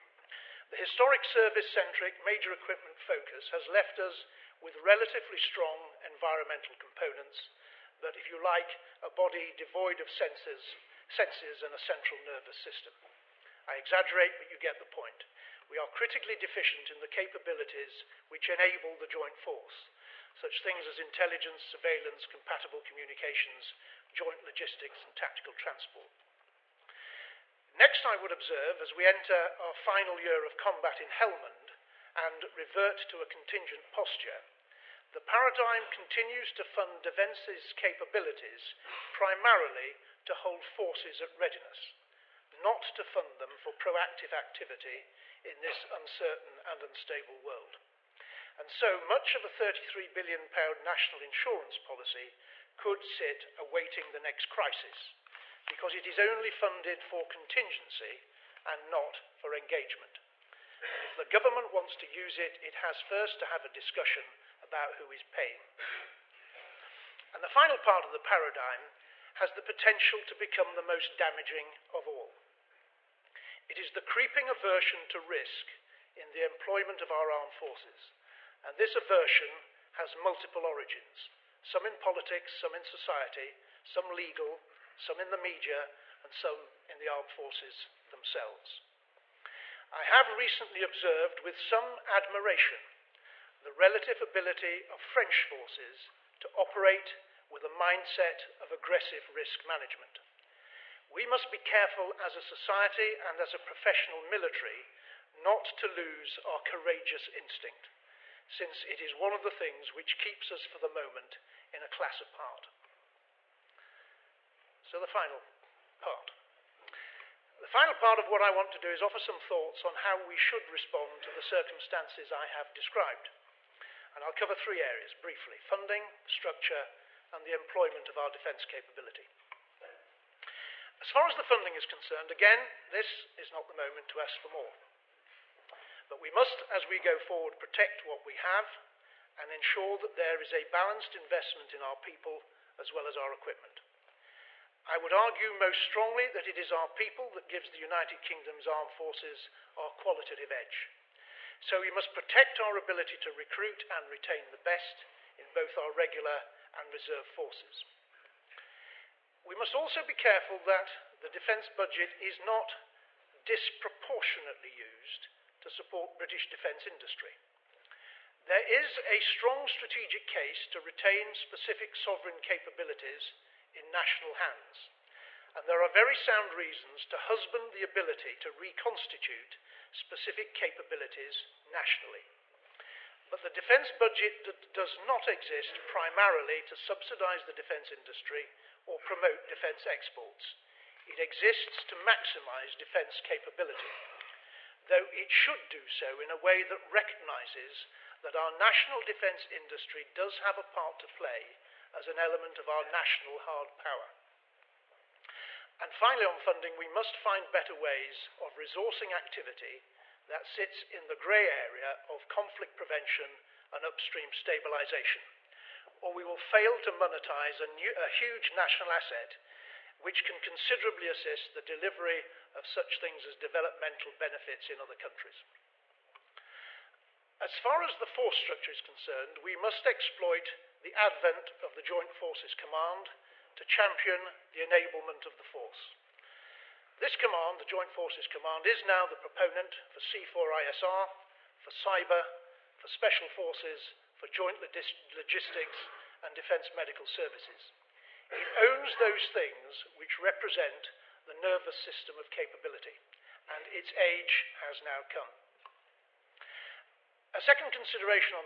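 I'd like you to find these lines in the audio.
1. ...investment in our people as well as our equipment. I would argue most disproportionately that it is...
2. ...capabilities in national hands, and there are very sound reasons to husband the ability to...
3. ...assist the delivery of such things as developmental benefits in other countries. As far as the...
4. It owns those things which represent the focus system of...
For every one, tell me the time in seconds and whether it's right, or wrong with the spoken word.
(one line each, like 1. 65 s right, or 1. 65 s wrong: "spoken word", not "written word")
1. 141 s wrong: "strongly", not "disproportionately"
2. 172 s right
3. 221 s right
4. 248 s wrong: "nervous", not "focus".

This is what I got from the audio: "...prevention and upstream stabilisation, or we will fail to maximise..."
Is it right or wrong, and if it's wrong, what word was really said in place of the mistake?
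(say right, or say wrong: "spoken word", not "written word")
wrong: "monetise", not "maximise".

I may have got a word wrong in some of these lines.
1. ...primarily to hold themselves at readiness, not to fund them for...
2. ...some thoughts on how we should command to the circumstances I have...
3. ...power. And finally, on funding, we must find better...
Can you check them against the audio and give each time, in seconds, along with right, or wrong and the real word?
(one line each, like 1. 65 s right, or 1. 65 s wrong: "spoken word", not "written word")
1. 39 s wrong: "forces", not "themselves"
2. 119 s wrong: "respond", not "command"
3. 203 s right.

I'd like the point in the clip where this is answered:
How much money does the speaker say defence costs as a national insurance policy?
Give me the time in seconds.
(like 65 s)
49 s.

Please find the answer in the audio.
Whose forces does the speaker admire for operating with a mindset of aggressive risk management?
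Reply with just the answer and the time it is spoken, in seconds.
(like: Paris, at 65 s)
French forces, at 94 s.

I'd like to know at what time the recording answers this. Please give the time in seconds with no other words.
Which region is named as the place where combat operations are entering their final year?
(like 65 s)
31 s.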